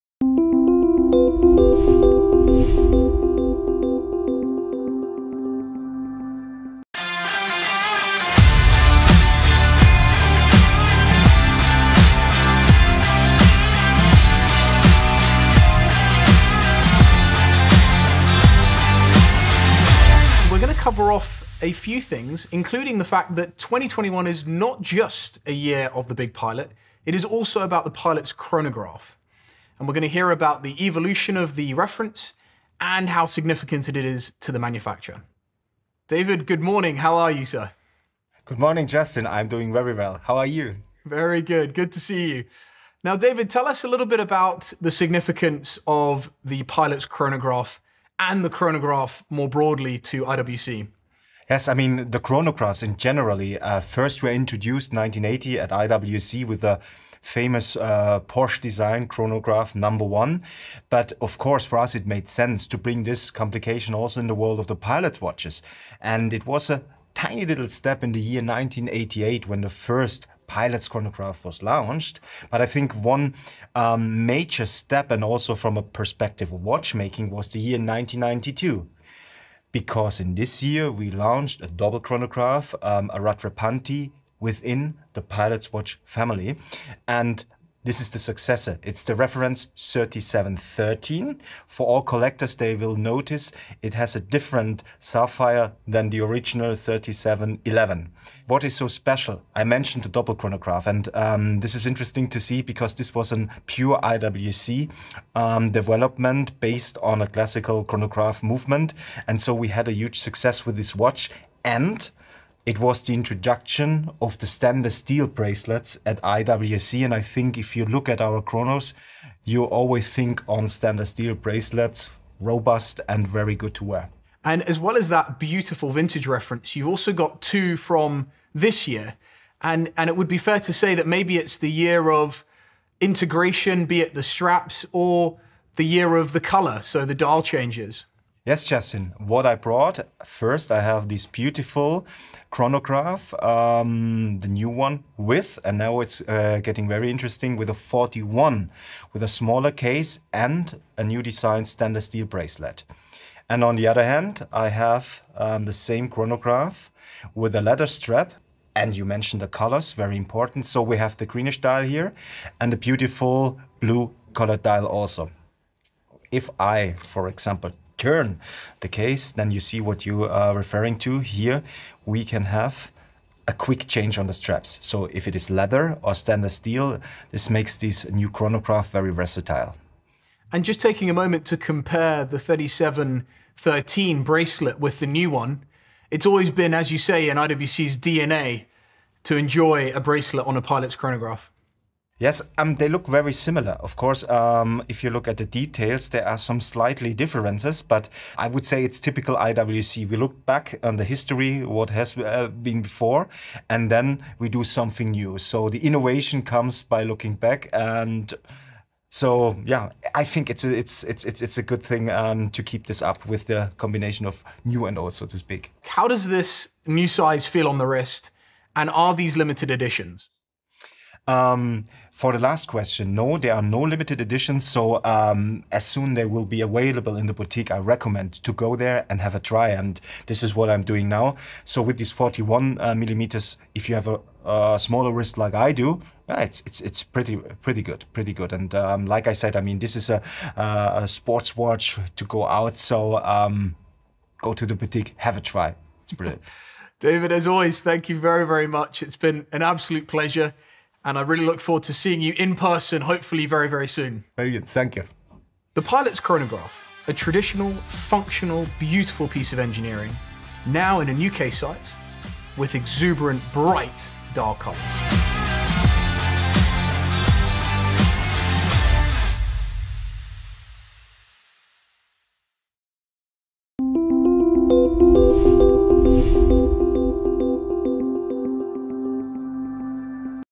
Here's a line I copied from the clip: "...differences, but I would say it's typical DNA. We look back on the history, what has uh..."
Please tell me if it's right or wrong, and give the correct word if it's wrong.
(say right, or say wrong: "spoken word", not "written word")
wrong: "IWC", not "DNA".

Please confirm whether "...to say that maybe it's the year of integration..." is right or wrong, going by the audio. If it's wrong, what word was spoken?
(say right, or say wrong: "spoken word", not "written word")
right.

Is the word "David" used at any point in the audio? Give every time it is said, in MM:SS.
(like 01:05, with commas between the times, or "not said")
00:36, 00:43, 04:06.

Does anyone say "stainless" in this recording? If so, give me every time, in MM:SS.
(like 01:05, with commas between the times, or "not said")
01:54, 02:00, 02:31, 02:56.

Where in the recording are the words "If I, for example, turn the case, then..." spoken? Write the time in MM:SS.
02:46.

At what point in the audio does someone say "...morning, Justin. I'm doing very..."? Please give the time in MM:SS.
00:38.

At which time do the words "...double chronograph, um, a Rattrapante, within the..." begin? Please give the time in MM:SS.
01:21.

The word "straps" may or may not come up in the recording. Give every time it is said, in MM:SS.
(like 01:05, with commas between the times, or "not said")
02:14, 02:37, 02:54.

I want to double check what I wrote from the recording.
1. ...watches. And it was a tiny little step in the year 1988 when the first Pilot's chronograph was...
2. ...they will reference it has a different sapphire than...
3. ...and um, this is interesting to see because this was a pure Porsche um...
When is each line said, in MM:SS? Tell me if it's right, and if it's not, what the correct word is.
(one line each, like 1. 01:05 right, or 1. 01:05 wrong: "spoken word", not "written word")
1. 01:05 right
2. 01:32 wrong: "notice", not "reference"
3. 01:40 wrong: "IWC", not "Porsche".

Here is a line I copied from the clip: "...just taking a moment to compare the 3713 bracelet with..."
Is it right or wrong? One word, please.
right.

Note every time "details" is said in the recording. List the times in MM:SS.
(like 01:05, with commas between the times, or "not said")
03:15.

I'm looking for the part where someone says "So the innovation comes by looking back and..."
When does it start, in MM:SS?
03:25.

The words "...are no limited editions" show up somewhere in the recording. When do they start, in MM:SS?
03:43.